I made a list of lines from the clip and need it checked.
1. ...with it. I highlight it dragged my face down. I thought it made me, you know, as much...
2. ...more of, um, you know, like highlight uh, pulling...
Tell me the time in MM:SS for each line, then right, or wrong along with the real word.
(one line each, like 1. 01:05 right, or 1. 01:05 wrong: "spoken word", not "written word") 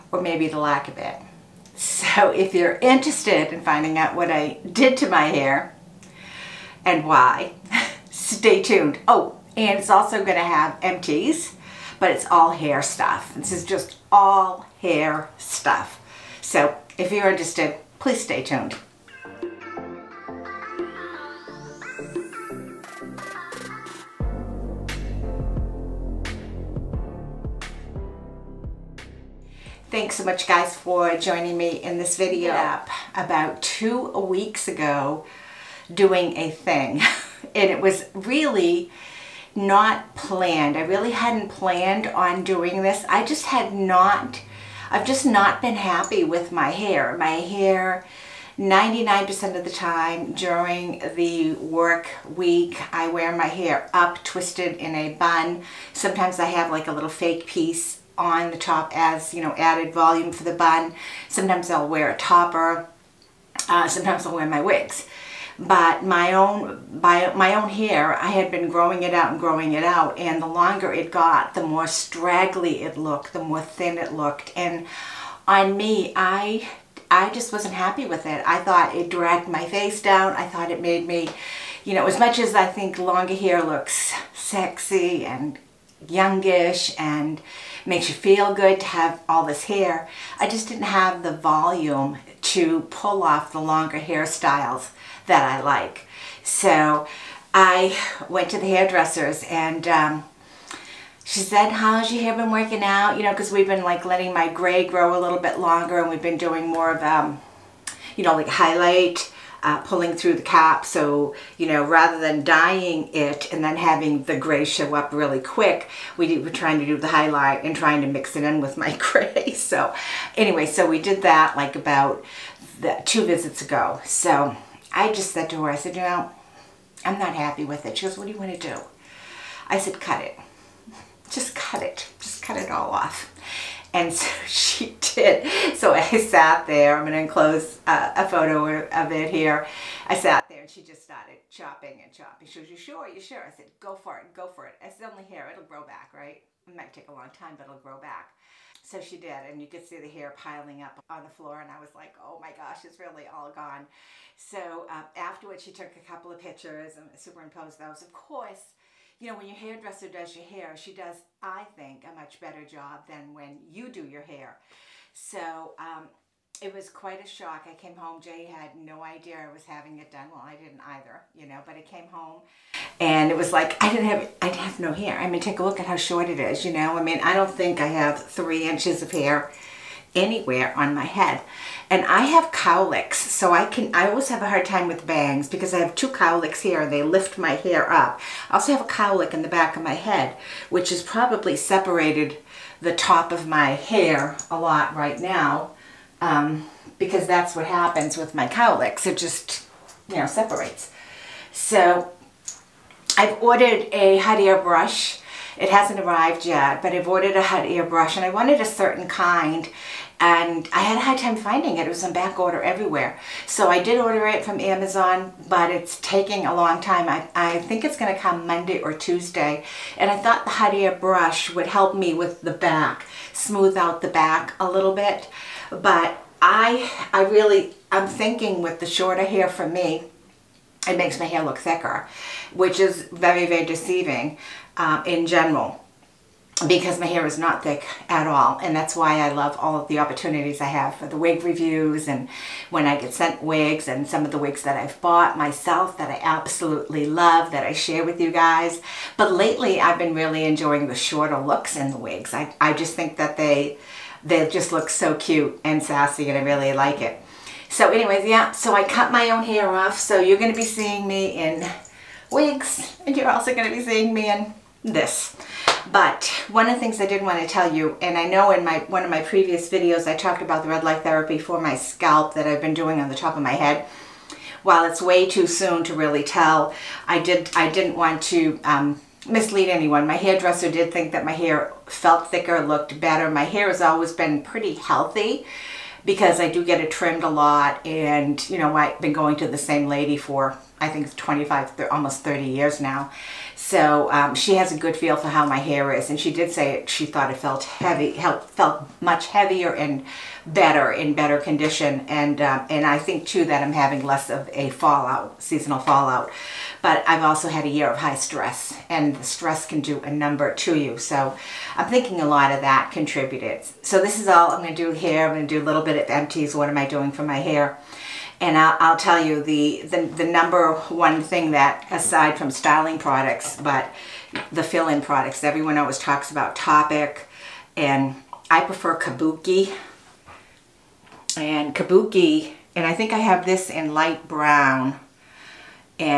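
1. 01:18 wrong: "thought", not "highlight"
2. 01:46 right.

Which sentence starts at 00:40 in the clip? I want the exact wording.
I really hadn't planned on doing this.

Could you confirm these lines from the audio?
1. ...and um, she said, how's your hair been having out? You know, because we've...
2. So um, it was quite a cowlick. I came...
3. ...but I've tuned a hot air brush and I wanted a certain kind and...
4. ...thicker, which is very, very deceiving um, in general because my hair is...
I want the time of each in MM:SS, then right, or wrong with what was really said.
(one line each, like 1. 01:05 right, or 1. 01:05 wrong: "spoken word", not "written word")
1. 01:39 wrong: "working", not "having"
2. 02:45 wrong: "shock", not "cowlick"
3. 03:26 wrong: "ordered", not "tuned"
4. 03:51 right.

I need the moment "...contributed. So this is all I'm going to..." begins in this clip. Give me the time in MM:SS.
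05:12.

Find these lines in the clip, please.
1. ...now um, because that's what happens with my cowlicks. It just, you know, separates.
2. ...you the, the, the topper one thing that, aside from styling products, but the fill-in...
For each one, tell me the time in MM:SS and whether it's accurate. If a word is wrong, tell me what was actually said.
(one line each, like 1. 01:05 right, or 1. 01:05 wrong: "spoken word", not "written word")
1. 03:15 right
2. 05:19 wrong: "number", not "topper".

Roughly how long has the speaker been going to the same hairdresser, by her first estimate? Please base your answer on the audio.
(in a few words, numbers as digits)
25 years.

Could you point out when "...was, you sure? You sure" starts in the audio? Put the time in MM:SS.
02:22.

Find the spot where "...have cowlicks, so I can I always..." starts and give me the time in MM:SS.
03:02.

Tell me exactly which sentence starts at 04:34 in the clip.
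While it's way too soon to really tell, I did I didn't want to um, mislead anyone.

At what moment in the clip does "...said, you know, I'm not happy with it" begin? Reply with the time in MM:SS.
02:05.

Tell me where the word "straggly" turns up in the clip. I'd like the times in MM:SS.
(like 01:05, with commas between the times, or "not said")
01:11.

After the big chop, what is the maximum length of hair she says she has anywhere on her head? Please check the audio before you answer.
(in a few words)
3 inches.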